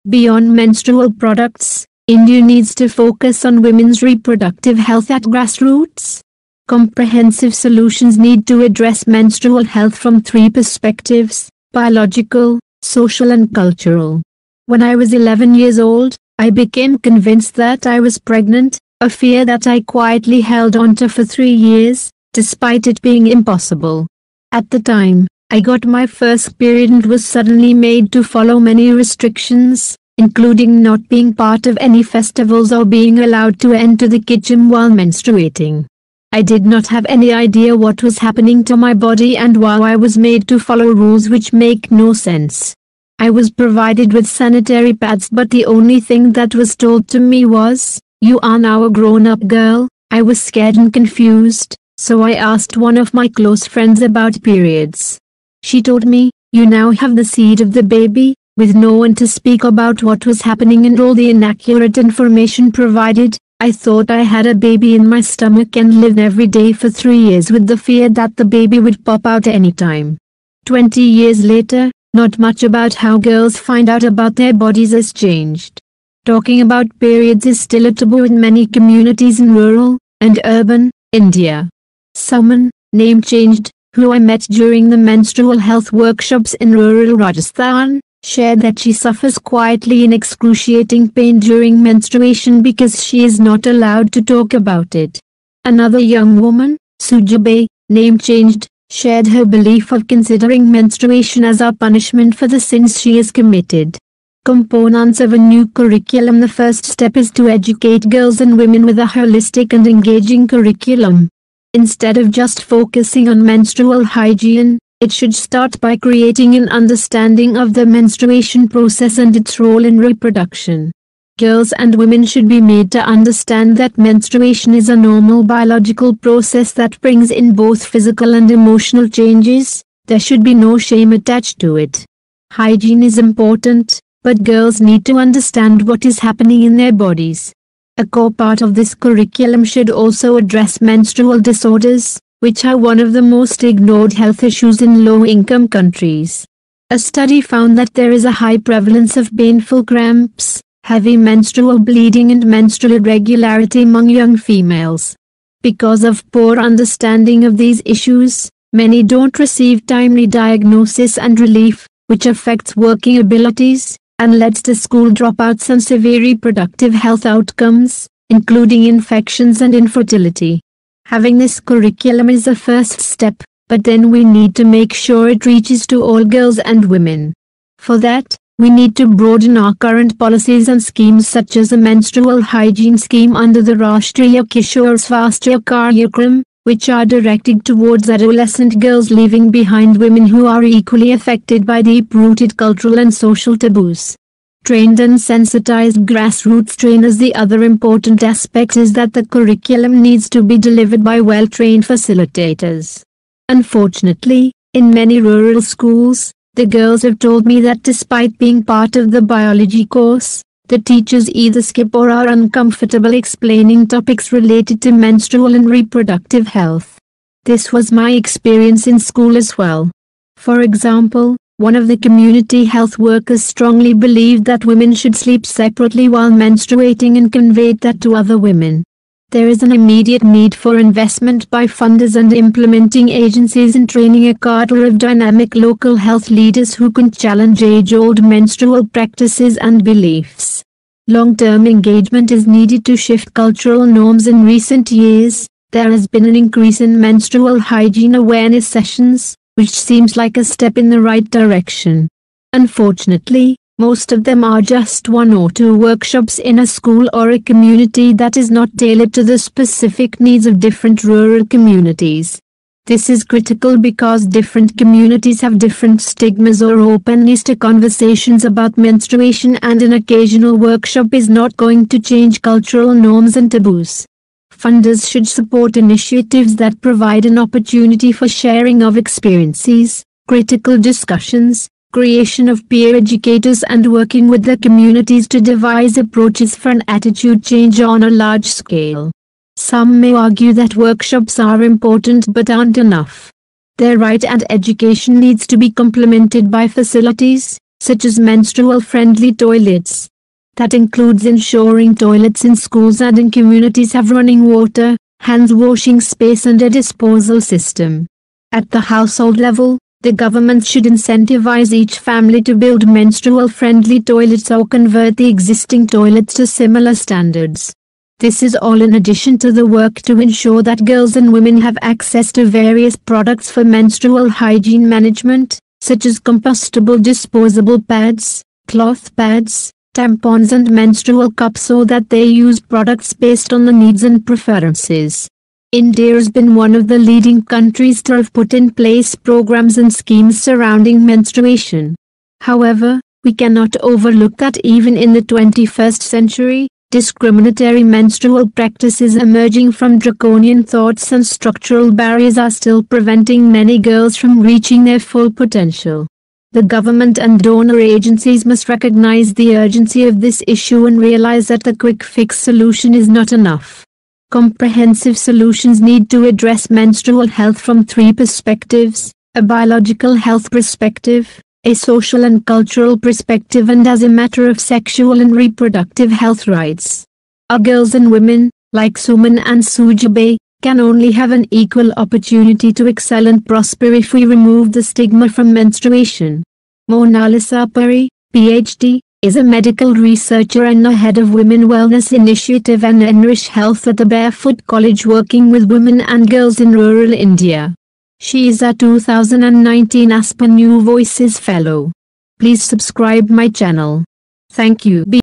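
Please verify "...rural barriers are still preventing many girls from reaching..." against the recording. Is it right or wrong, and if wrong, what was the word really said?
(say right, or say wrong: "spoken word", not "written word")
wrong: "structural", not "rural".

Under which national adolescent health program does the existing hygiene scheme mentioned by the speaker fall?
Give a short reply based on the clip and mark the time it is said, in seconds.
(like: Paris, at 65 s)
Rashtriya Kishore Swasthya Karyakram, at 183 s.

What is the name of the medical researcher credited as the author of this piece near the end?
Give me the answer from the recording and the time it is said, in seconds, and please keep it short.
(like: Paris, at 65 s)
Monalisa Padhee, at 386 s.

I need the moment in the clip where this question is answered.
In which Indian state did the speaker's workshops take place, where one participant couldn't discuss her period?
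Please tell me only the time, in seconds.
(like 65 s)
87 s.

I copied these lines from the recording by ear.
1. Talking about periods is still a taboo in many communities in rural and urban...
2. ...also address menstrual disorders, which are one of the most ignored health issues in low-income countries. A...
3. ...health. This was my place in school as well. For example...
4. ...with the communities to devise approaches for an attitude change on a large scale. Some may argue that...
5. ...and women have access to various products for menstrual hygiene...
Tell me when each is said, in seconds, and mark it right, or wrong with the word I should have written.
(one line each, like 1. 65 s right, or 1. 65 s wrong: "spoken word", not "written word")
1. 76 s right
2. 139 s right
3. 216 s wrong: "experience", not "place"
4. 284 s right
5. 321 s right.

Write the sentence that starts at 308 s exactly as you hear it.
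At the household level, the government should incentivize each family to build menstrual-friendly toilets or convert the existing toilets to similar standards.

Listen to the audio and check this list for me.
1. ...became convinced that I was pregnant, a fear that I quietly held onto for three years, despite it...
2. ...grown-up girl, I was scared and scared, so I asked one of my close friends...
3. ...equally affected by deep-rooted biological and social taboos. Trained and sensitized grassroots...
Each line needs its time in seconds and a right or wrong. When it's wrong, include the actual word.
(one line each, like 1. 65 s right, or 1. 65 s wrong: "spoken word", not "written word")
1. 16 s right
2. 48 s wrong: "confused", not "scared"
3. 190 s wrong: "cultural", not "biological".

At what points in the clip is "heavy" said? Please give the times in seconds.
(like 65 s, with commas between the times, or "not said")
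150 s.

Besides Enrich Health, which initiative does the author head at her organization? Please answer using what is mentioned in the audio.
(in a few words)
Women Wellness Initiative.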